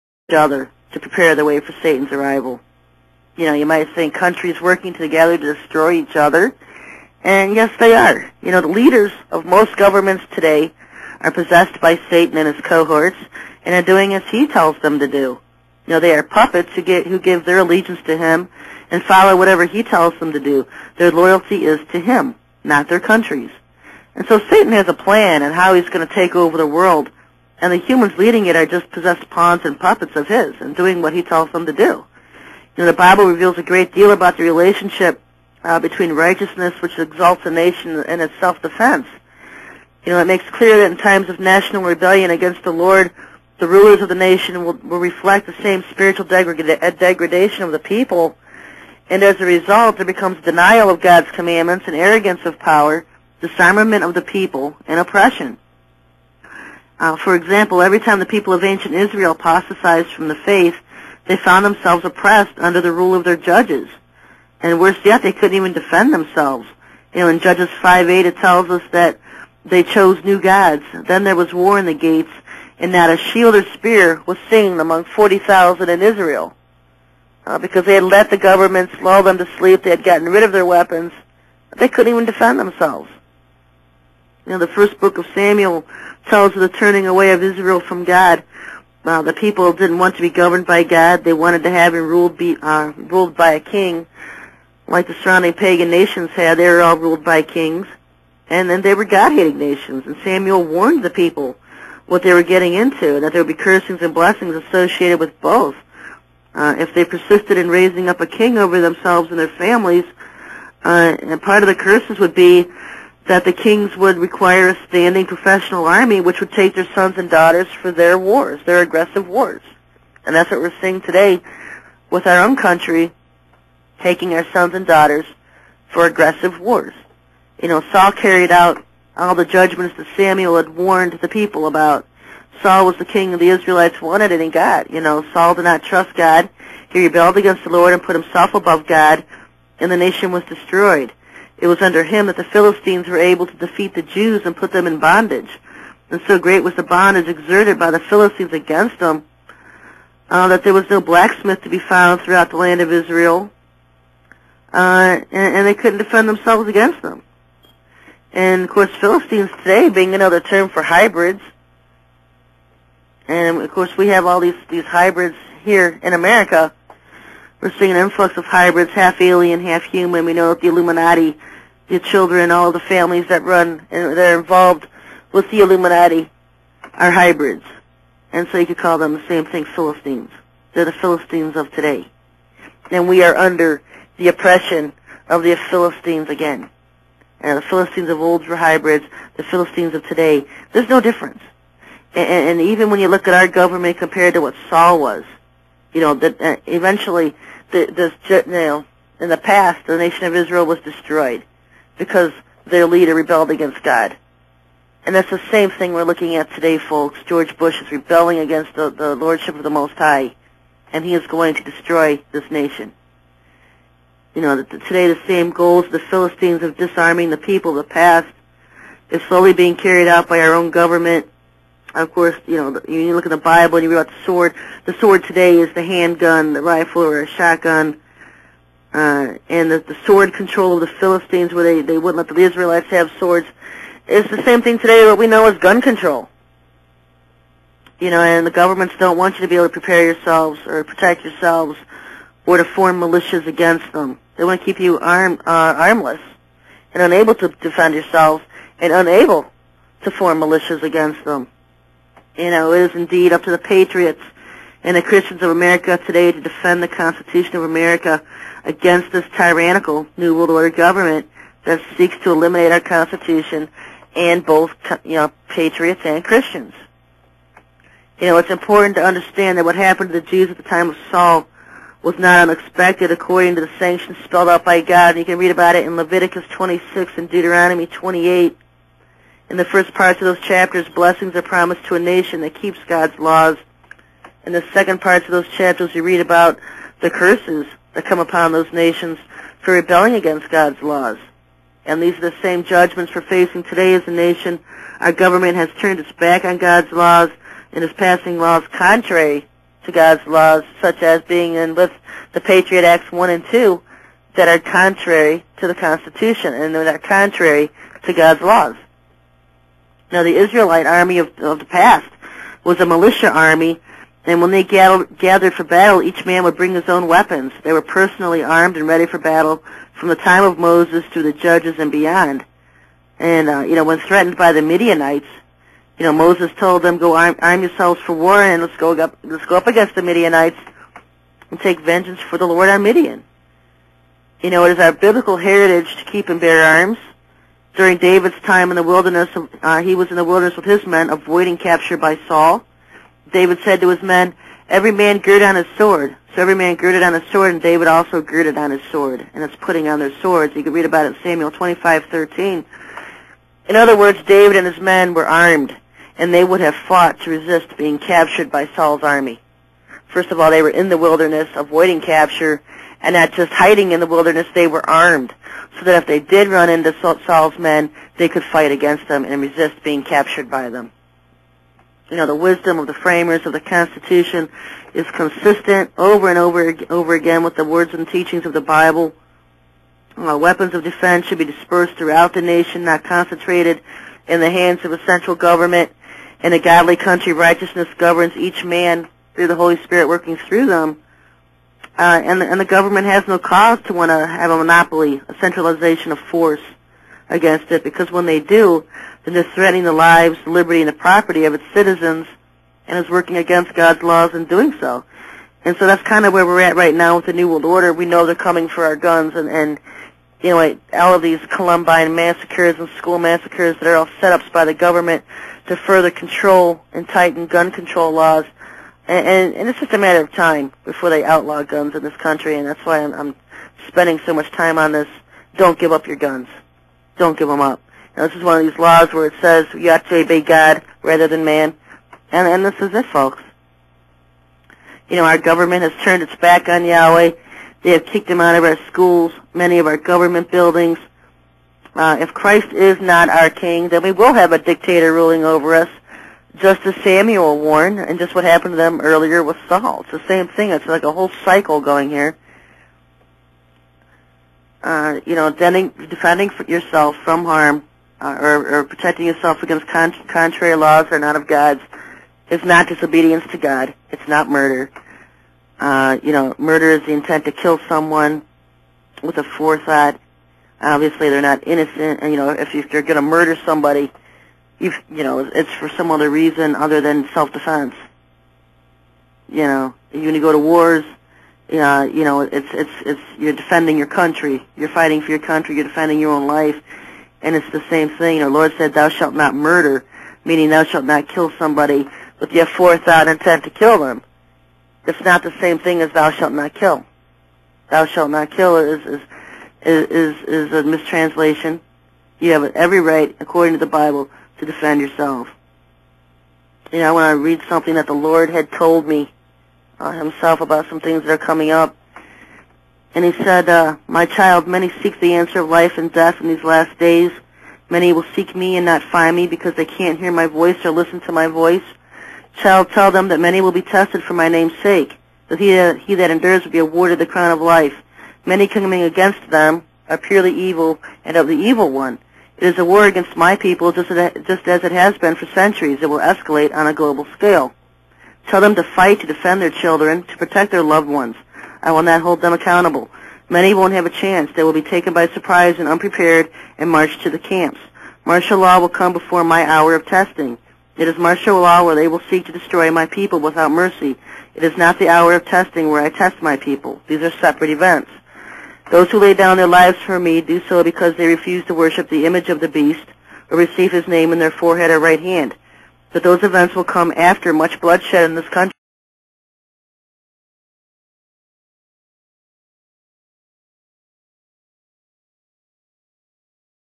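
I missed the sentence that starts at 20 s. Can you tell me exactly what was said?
Their loyalty is to him, not their countries.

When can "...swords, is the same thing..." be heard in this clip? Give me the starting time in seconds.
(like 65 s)
233 s.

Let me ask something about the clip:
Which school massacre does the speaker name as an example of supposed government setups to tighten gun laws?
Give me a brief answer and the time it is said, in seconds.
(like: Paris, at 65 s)
Columbine, at 411 s.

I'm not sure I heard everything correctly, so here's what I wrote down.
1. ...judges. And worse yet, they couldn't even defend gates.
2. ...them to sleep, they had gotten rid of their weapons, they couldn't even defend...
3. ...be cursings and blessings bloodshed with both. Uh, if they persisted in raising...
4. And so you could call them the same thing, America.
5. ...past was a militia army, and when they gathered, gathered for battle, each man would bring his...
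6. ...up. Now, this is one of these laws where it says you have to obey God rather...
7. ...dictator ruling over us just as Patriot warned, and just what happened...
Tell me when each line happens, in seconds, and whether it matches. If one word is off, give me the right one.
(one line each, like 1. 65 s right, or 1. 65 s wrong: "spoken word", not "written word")
1. 63 s wrong: "themselves", not "gates"
2. 79 s right
3. 103 s wrong: "associated", not "bloodshed"
4. 178 s wrong: "Philistines", not "America"
5. 311 s right
6. 427 s right
7. 444 s wrong: "Samuel", not "Patriot".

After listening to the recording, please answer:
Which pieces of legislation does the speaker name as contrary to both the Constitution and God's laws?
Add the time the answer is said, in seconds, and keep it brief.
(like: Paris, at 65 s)
Patriot Acts 1 and 2, at 302 s.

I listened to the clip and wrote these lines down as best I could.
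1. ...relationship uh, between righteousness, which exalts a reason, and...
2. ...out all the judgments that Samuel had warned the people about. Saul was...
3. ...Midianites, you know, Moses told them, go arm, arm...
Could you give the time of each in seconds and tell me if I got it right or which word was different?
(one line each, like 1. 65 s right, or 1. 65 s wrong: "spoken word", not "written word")
1. 34 s wrong: "nation", not "reason"
2. 128 s right
3. 324 s right.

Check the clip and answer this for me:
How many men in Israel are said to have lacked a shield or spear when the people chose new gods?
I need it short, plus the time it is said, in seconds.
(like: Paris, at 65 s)
40,000, at 75 s.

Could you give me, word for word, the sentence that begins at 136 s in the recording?
He rebelled against the Lord and put himself above God, and the nation was destroyed.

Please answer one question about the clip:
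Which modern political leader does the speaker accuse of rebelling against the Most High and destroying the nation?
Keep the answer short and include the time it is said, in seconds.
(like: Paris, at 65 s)
George Bush, at 207 s.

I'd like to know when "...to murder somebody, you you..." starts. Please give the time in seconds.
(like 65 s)
473 s.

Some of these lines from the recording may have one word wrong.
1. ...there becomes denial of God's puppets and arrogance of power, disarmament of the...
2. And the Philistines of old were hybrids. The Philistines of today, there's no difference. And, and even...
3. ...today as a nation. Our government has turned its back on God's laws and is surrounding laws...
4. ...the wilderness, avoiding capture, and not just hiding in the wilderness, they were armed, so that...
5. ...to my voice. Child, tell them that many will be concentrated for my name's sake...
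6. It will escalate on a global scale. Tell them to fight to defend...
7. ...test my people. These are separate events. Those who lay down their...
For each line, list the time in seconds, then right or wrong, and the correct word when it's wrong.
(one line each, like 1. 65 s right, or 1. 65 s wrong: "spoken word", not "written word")
1. 49 s wrong: "commandments", not "puppets"
2. 187 s right
3. 293 s wrong: "passing", not "surrounding"
4. 360 s right
5. 521 s wrong: "tested", not "concentrated"
6. 535 s right
7. 556 s right.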